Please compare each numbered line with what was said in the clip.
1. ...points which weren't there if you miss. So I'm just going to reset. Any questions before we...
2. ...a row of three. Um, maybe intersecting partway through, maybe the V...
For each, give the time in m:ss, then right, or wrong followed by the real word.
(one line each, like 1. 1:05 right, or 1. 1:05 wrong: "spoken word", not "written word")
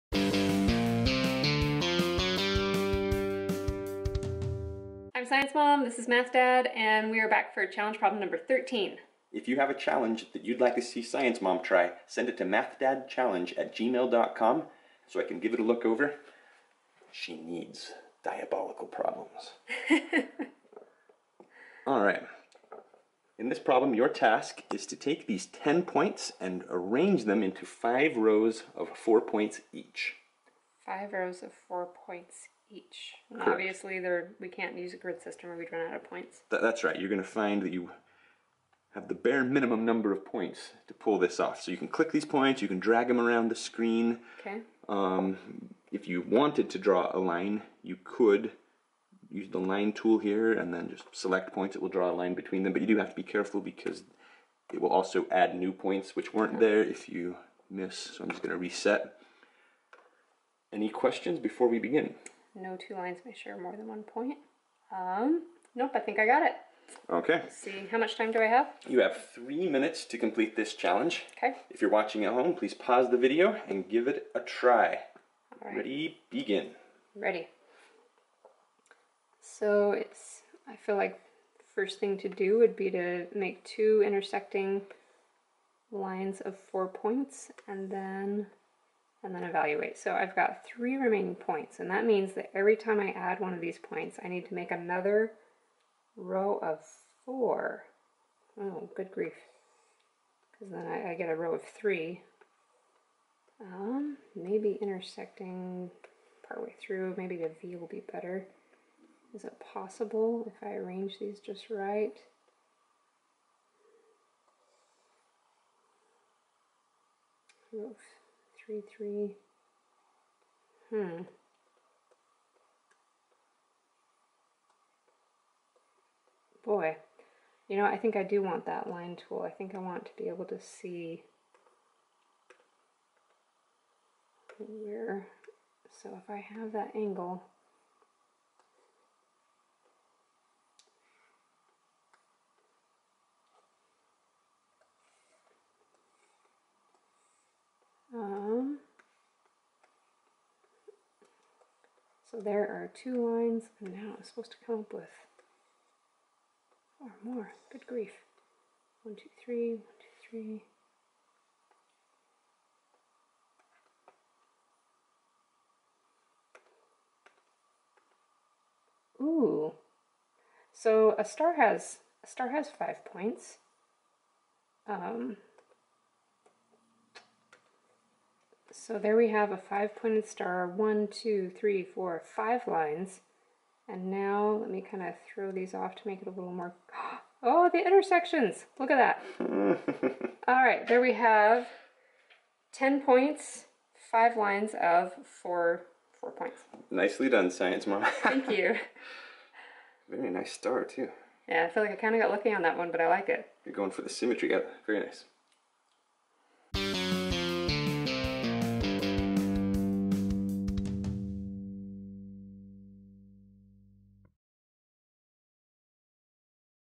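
1. 0:55 right
2. 1:41 right.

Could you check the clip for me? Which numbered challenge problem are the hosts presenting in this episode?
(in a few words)
13.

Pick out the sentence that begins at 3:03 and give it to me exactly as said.
And now let me kind of throw these off to make it a little more...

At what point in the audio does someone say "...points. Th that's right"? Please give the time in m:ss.
0:36.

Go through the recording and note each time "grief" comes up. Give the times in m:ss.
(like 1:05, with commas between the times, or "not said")
1:39, 2:37.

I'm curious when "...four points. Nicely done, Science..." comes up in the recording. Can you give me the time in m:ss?
3:16.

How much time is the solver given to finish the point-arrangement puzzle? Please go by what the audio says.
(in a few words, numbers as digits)
3 minutes.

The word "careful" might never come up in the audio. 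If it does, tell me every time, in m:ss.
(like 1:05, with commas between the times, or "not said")
0:53.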